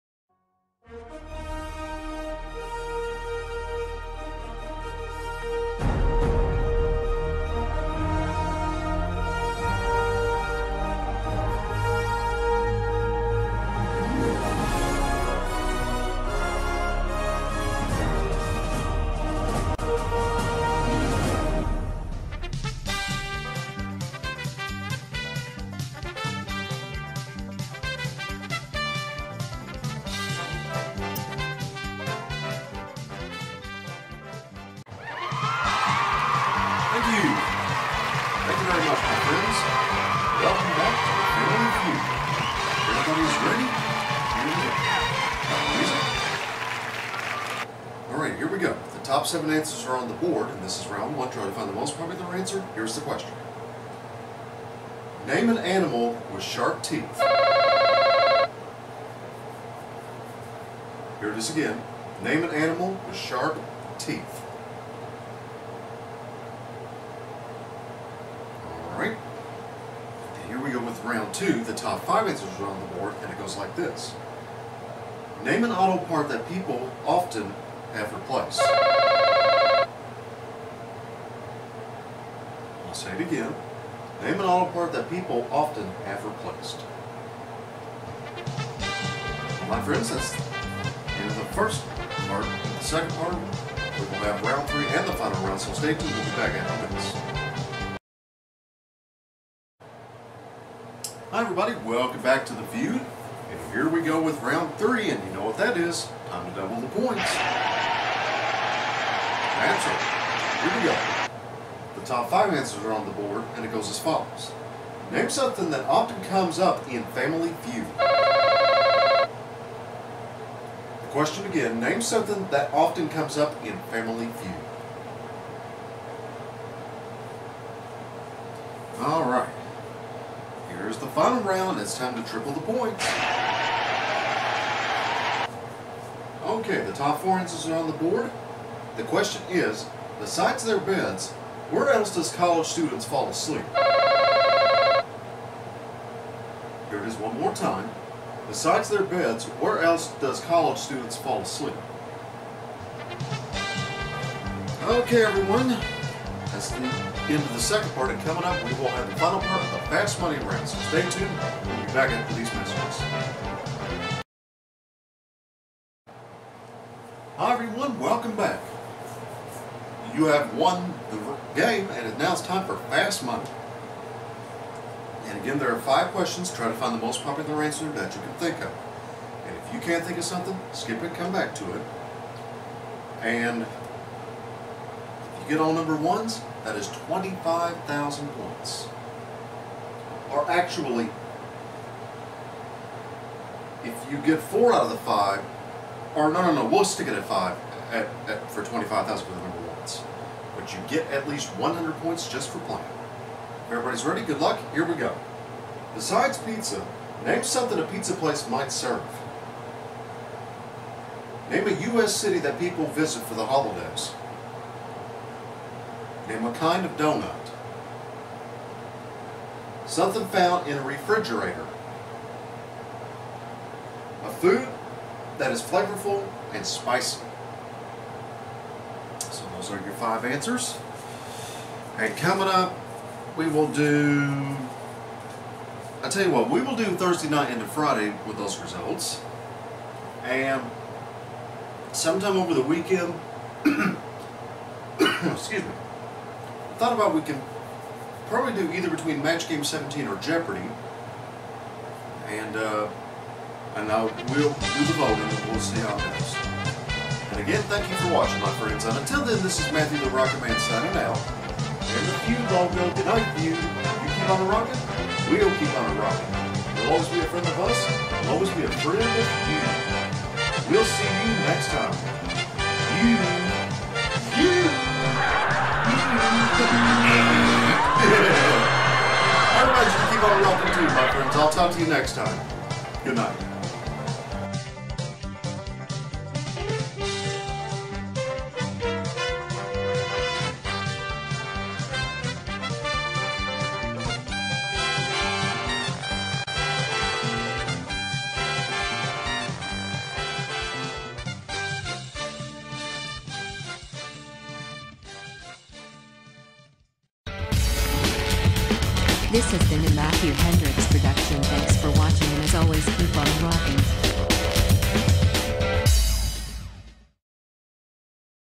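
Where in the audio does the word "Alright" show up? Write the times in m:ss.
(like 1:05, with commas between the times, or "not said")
1:08, 2:09.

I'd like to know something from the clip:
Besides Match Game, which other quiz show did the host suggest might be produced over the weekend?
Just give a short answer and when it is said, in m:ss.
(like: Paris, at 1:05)
Jeopardy, at 4:10.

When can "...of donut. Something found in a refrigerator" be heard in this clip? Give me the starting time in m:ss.
3:36.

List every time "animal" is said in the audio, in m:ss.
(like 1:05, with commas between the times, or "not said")
0:55, 1:02.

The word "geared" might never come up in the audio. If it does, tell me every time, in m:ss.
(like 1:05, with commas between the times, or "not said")
not said.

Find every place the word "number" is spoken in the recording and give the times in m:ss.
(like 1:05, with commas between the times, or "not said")
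3:05, 3:19.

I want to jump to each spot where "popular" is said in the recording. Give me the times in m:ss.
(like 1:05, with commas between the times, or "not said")
0:51, 2:57.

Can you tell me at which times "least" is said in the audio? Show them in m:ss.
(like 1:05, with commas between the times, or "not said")
3:21.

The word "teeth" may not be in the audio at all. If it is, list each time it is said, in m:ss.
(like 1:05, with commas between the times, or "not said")
0:56, 1:03.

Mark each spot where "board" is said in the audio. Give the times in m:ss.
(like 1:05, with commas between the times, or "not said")
0:50, 1:12, 1:53, 2:17.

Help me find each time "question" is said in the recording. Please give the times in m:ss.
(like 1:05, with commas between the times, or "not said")
0:53, 2:01, 2:19, 2:56.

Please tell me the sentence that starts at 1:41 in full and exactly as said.
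Hi everybody, welcome back to The View.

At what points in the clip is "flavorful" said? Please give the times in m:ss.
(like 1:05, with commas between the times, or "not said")
3:45.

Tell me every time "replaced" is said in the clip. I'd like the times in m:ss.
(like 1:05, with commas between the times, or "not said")
1:18, 1:26.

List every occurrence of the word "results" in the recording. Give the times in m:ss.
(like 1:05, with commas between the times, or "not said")
3:58.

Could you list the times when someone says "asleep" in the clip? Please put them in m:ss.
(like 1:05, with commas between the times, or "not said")
2:23, 2:31.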